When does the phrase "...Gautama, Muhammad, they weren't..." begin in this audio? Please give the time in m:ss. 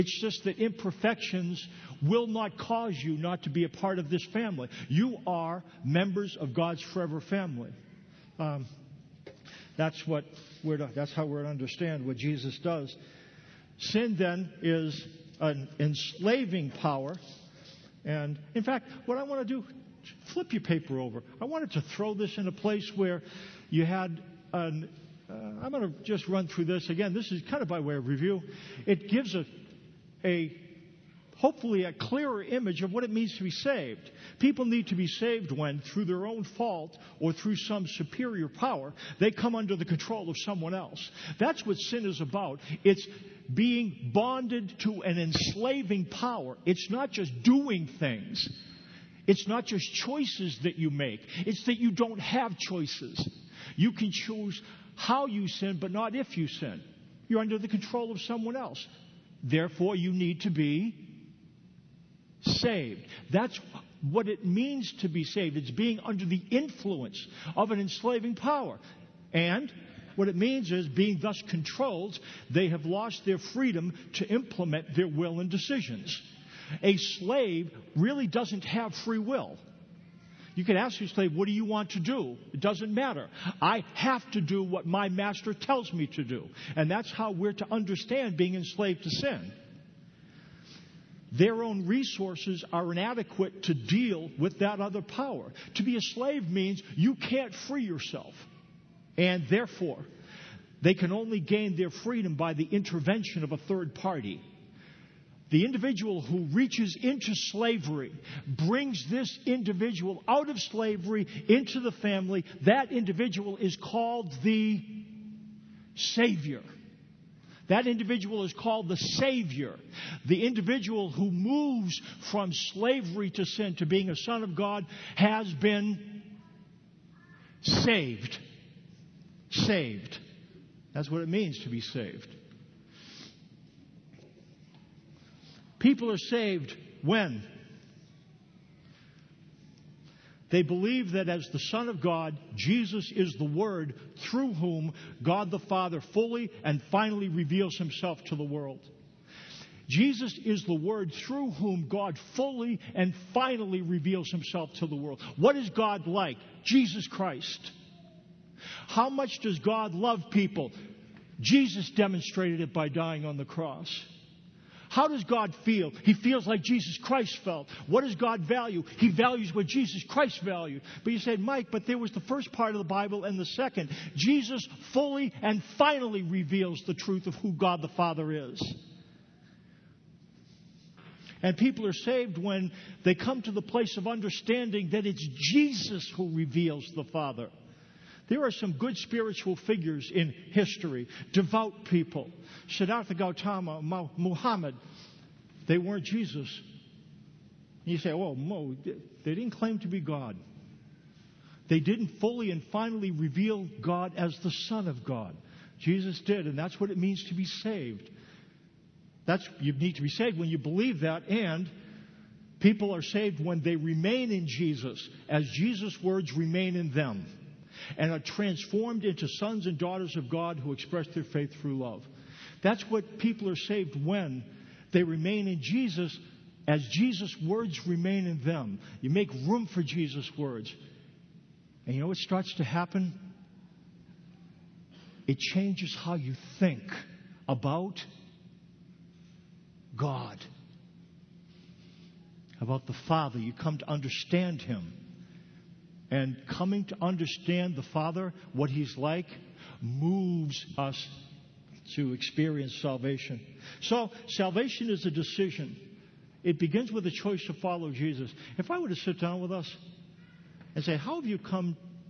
3:13.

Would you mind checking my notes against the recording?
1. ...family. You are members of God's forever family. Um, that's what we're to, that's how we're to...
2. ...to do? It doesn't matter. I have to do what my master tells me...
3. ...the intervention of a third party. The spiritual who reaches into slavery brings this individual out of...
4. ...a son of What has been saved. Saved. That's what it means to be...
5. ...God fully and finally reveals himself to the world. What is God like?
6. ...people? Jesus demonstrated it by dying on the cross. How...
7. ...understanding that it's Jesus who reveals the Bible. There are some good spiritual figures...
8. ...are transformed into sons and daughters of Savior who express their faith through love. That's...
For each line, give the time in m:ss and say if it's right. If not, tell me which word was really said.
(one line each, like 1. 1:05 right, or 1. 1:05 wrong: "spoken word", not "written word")
1. 0:04 right
2. 1:21 right
3. 1:42 wrong: "individual", not "spiritual"
4. 2:04 wrong: "God", not "What"
5. 2:31 right
6. 2:40 right
7. 3:04 wrong: "Father", not "Bible"
8. 3:38 wrong: "God", not "Savior".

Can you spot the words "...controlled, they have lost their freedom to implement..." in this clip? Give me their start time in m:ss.
1:11.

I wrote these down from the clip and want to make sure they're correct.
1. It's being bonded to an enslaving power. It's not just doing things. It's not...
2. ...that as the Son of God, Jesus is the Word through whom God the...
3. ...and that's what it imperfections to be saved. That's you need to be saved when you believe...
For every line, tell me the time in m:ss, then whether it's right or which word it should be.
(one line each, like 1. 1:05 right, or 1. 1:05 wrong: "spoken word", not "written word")
1. 0:42 right
2. 2:21 right
3. 3:26 wrong: "means", not "imperfections".